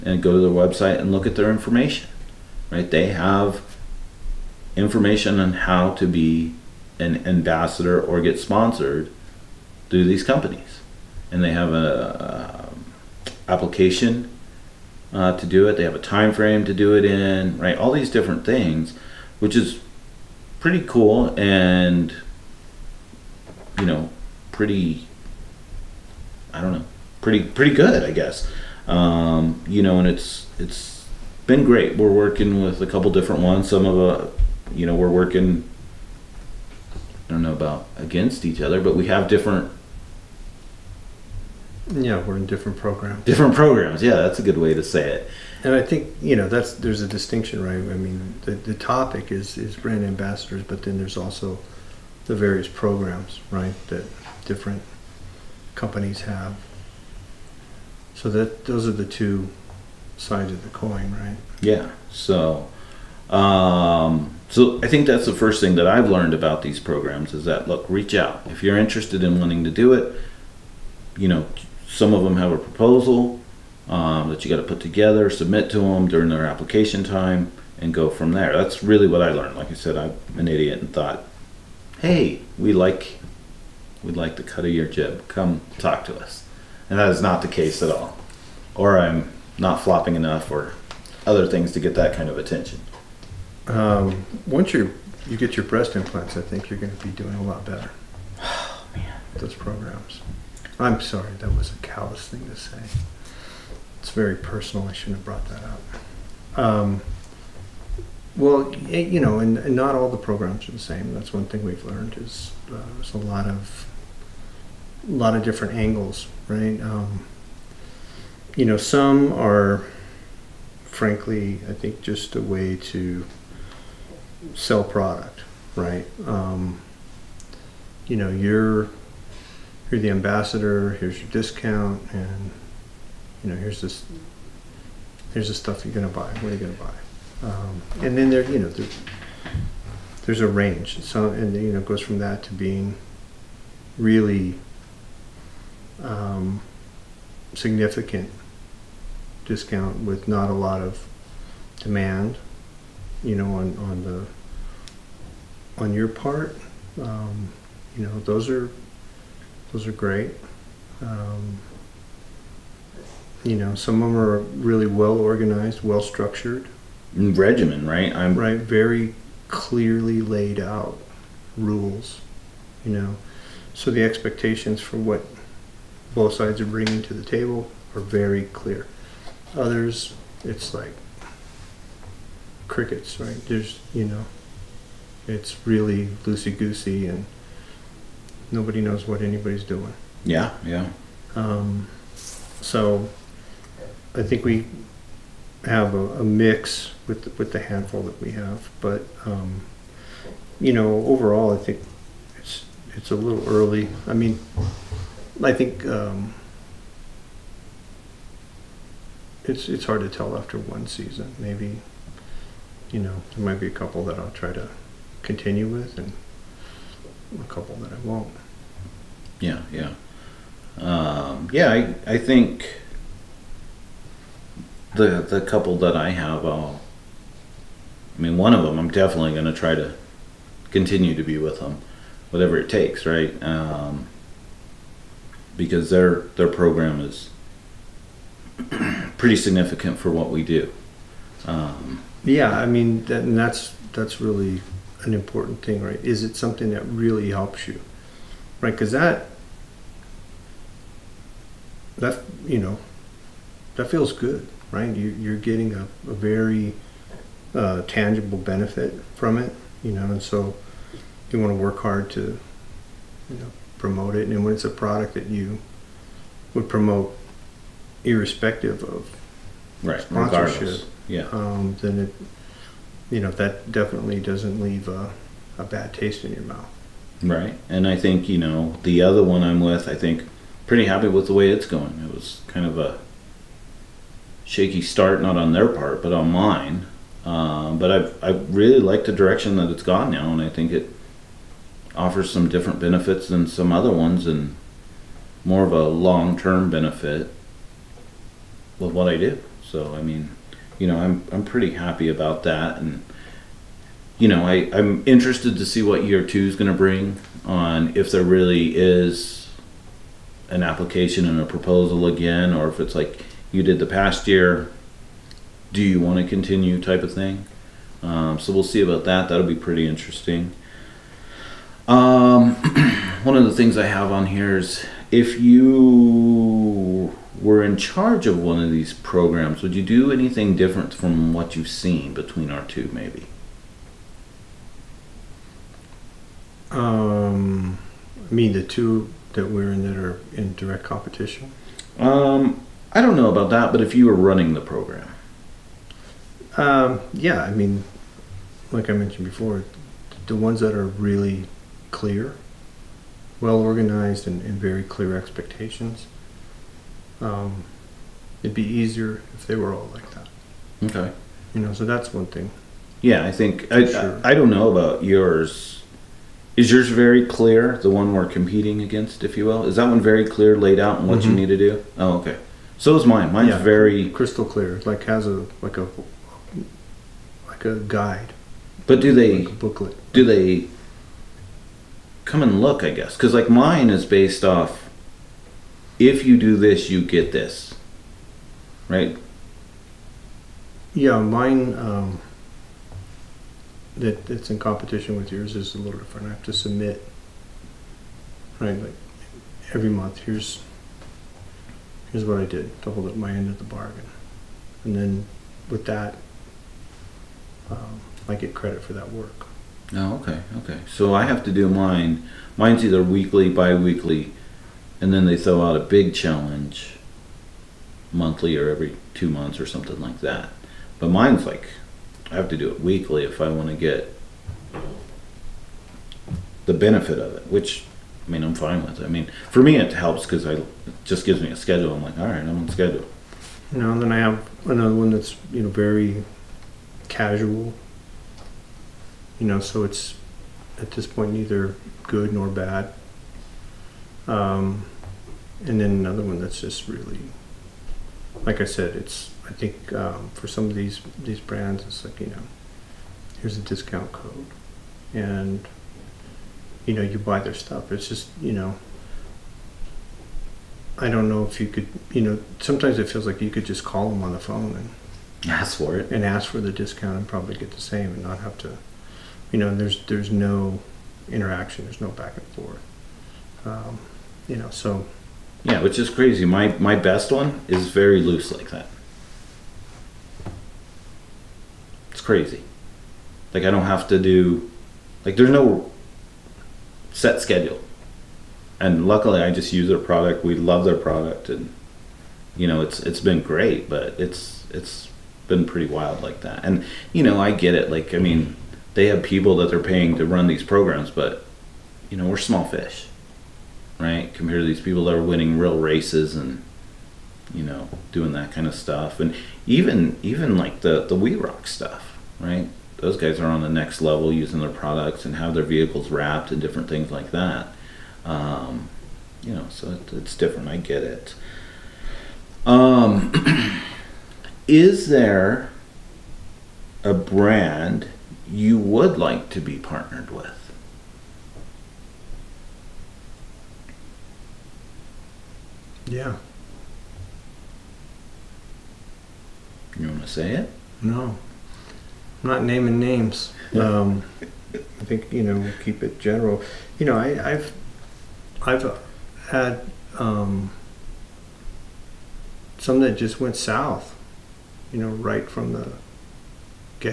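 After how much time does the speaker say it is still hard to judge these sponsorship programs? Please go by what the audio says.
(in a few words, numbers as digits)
one season.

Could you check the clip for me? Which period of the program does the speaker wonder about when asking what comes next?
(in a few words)
year two.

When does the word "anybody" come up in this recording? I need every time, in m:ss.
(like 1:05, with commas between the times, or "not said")
3:09.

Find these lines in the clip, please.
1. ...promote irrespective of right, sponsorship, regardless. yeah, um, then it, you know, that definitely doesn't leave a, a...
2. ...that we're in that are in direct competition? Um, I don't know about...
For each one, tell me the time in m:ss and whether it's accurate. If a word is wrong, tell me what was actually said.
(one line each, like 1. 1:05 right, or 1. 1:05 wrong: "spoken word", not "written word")
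1. 4:26 right
2. 5:39 right.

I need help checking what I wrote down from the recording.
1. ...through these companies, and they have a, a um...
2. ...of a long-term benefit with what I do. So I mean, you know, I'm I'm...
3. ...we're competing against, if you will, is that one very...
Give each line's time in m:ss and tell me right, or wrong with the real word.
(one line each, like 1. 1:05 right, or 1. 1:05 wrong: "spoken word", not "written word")
1. 0:09 right
2. 4:55 right
3. 6:08 right.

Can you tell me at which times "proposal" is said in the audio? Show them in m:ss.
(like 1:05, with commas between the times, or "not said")
1:12, 5:11.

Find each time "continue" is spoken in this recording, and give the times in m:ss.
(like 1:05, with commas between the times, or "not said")
3:35, 3:50, 5:16.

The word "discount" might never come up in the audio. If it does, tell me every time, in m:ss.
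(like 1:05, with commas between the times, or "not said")
2:11, 2:29, 7:33, 7:46.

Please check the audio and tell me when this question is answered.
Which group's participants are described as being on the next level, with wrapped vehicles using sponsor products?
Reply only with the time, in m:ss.
8:31.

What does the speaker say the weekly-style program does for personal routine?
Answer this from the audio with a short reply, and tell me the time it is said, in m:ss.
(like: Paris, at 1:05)
gives me a schedule, at 7:11.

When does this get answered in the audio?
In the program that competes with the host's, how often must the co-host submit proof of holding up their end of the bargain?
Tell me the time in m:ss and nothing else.
6:39.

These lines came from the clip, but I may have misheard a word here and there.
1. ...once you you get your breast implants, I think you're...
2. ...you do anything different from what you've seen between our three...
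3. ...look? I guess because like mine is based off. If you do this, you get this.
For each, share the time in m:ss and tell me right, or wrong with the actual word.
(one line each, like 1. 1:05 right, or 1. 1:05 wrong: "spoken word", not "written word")
1. 1:34 right
2. 5:29 wrong: "two", not "three"
3. 6:22 right.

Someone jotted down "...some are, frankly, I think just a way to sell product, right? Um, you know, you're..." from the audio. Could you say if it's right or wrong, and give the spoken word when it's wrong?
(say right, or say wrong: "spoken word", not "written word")
right.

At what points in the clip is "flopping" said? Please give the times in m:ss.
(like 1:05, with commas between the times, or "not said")
1:29.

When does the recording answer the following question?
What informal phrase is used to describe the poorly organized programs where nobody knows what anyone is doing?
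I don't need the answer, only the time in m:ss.
3:06.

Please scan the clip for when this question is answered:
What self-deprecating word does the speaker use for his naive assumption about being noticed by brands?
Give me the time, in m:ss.
1:20.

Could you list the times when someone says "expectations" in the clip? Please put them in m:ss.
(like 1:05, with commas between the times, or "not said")
2:54, 5:55.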